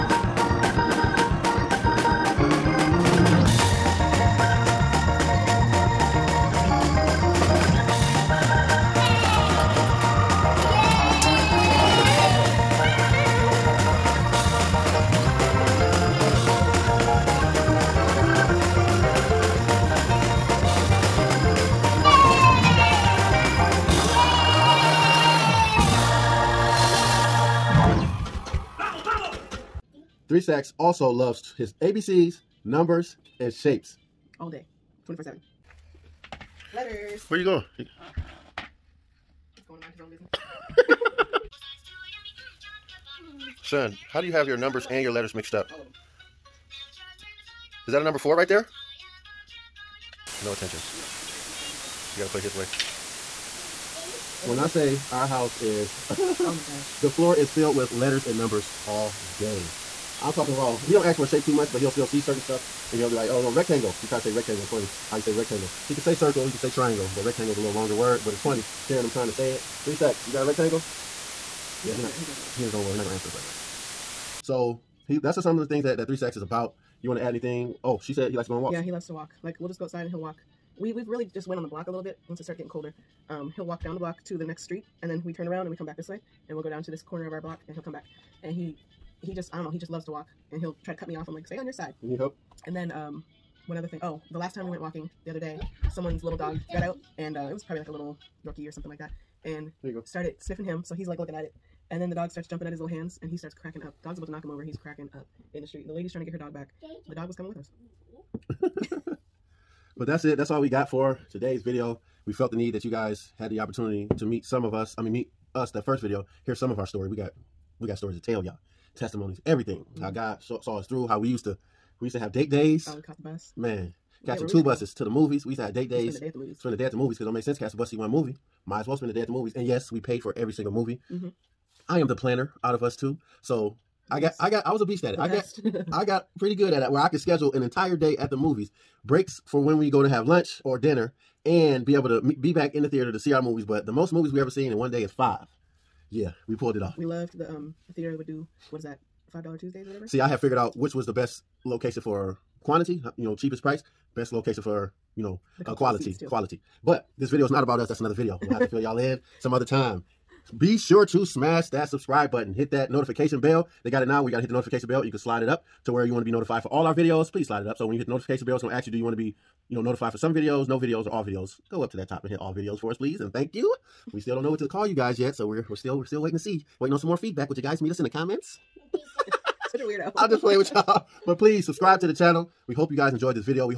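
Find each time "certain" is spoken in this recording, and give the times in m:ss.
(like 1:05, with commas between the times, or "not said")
1:02.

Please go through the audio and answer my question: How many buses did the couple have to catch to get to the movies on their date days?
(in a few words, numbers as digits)
2.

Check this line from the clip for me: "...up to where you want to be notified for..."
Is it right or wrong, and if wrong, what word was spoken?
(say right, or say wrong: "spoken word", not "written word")
right.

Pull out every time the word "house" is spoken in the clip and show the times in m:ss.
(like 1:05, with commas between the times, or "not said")
0:55.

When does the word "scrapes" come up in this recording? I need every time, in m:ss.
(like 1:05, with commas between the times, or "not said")
not said.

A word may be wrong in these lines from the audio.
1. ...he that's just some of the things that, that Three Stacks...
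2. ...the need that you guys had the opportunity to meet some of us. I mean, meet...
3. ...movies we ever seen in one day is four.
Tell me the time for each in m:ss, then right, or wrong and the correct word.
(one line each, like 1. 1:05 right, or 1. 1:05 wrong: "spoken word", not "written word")
1. 1:15 right
2. 1:52 right
3. 2:24 wrong: "five", not "four".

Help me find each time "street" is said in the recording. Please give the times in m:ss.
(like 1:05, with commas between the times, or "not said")
1:24, 1:45.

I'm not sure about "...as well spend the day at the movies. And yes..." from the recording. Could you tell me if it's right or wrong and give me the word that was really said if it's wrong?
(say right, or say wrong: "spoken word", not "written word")
right.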